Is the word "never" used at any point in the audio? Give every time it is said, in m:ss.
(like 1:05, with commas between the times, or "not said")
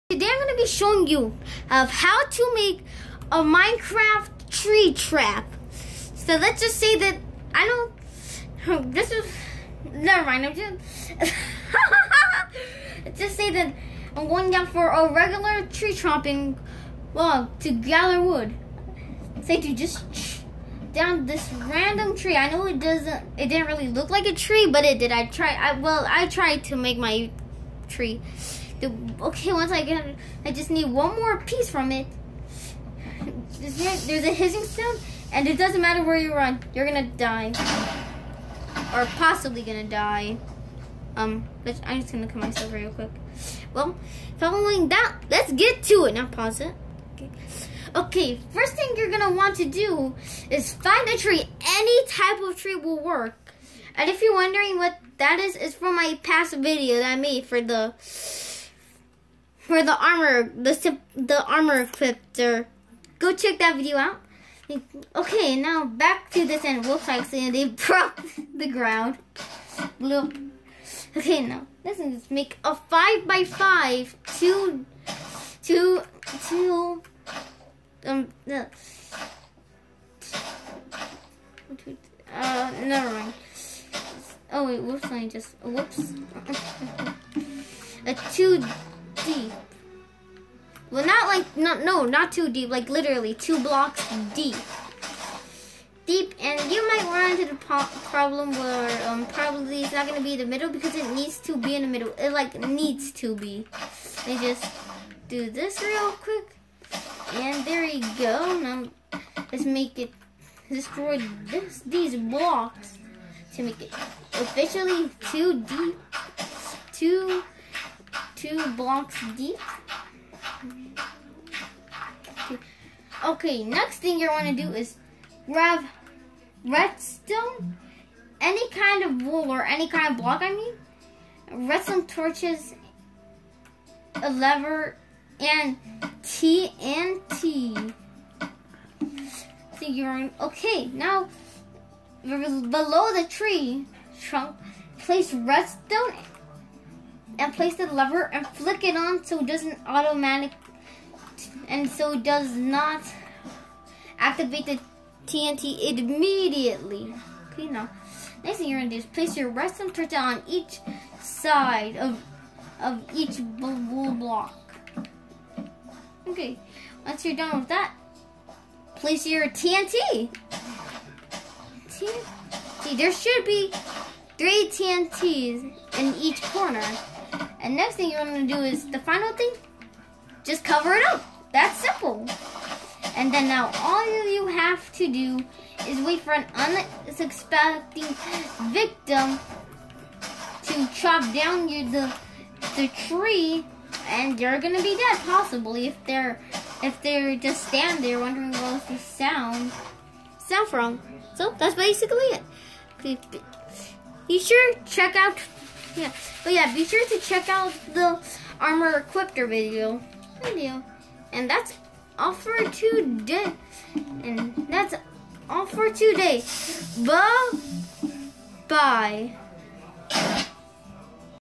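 0:09, 1:22.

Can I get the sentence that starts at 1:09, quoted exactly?
Blew Okay, now let's just make a five by five, two, two, two, um, no.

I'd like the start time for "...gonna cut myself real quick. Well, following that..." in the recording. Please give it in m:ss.
0:42.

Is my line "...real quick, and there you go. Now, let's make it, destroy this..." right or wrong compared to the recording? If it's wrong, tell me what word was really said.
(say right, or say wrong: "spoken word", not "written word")
right.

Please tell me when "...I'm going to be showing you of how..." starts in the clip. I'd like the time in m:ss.
0:00.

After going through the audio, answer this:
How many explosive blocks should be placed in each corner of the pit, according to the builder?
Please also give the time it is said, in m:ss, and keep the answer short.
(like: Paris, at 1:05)
3, at 2:54.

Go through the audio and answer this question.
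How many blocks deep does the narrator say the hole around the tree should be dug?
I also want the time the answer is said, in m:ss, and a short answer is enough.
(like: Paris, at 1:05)
2, at 1:33.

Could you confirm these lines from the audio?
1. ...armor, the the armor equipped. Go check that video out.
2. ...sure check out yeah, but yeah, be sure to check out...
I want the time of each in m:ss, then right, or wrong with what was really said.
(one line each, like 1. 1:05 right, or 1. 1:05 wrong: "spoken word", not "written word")
1. 0:59 right
2. 3:24 right.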